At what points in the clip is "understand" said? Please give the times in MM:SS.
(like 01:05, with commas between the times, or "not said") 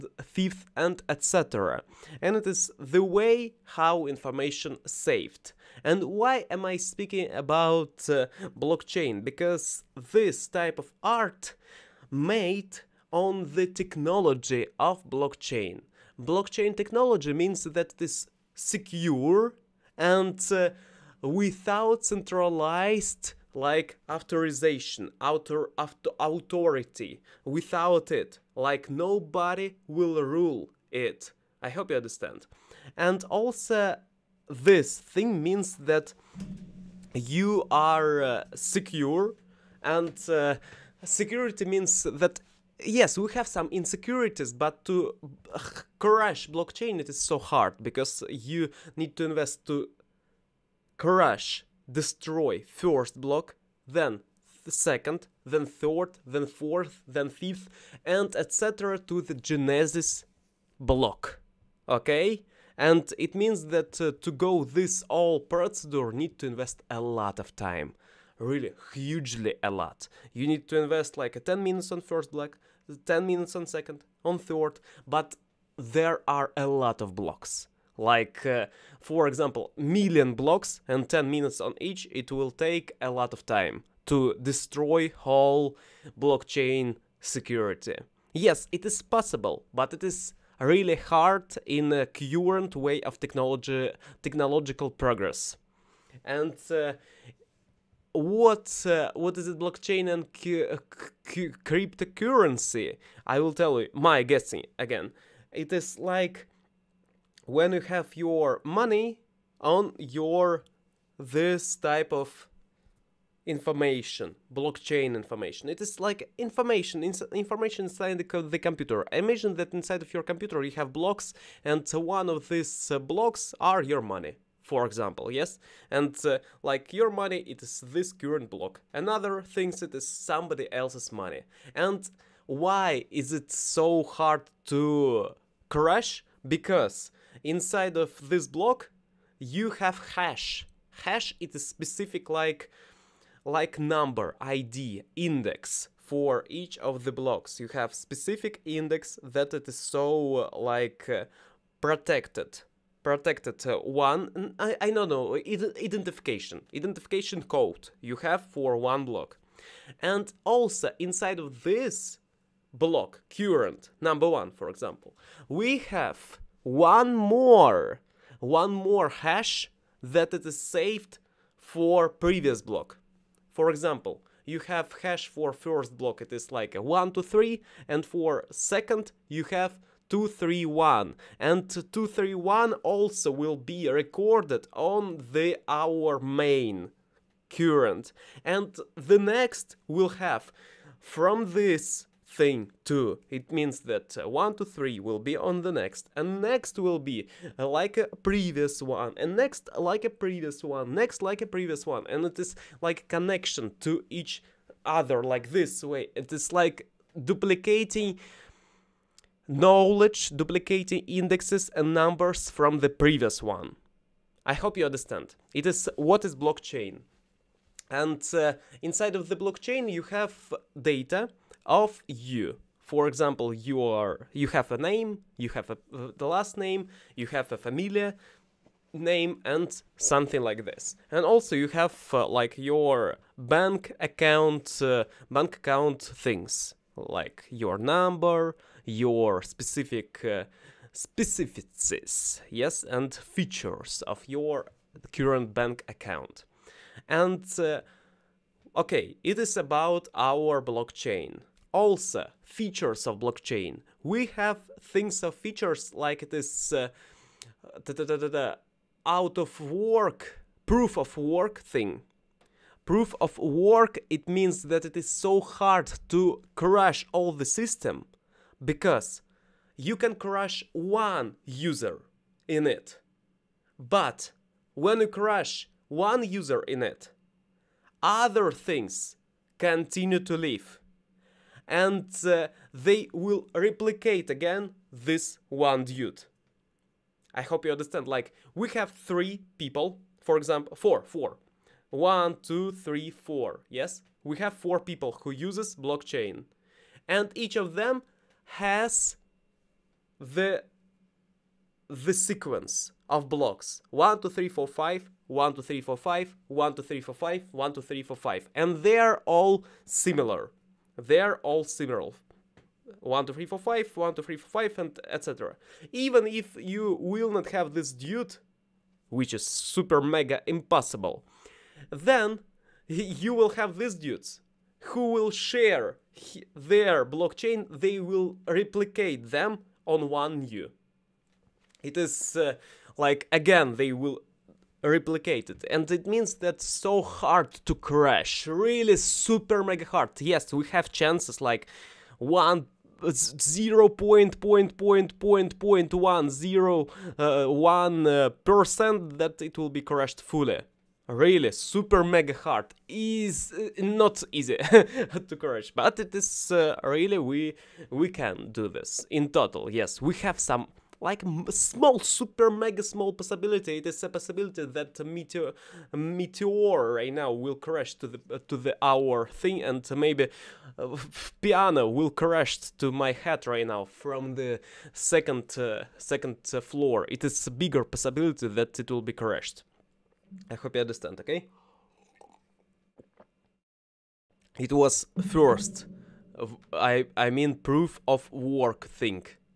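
00:31, 03:34, 04:47, 06:20.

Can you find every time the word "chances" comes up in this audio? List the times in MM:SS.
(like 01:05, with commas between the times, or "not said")
05:40.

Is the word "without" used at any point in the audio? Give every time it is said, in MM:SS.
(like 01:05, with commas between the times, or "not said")
00:21, 00:27.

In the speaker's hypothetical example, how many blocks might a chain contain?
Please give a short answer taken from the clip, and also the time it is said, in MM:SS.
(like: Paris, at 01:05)
million blocks, at 01:19.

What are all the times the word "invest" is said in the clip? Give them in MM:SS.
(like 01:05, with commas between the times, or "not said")
00:49, 01:06, 01:10.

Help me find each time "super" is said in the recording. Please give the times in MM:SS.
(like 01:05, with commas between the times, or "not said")
05:19, 05:38, 05:51, 06:02.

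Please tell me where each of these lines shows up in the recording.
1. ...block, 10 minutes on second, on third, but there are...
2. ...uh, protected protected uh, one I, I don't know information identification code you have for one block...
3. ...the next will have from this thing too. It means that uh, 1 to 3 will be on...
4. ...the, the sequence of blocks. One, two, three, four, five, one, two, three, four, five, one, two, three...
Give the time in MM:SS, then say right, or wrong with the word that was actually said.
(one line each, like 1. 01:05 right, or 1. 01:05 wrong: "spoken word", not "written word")
1. 01:12 right
2. 02:31 wrong: "identification", not "information"
3. 03:08 right
4. 05:00 right.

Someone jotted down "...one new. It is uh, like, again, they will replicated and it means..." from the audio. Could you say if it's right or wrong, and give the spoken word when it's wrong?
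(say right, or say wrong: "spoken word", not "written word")
right.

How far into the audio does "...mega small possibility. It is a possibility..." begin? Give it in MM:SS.
06:02.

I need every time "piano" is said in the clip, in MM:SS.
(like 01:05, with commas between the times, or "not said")
06:11.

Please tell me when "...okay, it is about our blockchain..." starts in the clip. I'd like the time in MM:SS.
04:08.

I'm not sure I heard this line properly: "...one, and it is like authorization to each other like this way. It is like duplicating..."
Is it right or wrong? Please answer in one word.
wrong.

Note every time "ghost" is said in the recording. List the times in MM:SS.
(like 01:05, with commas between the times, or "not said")
not said.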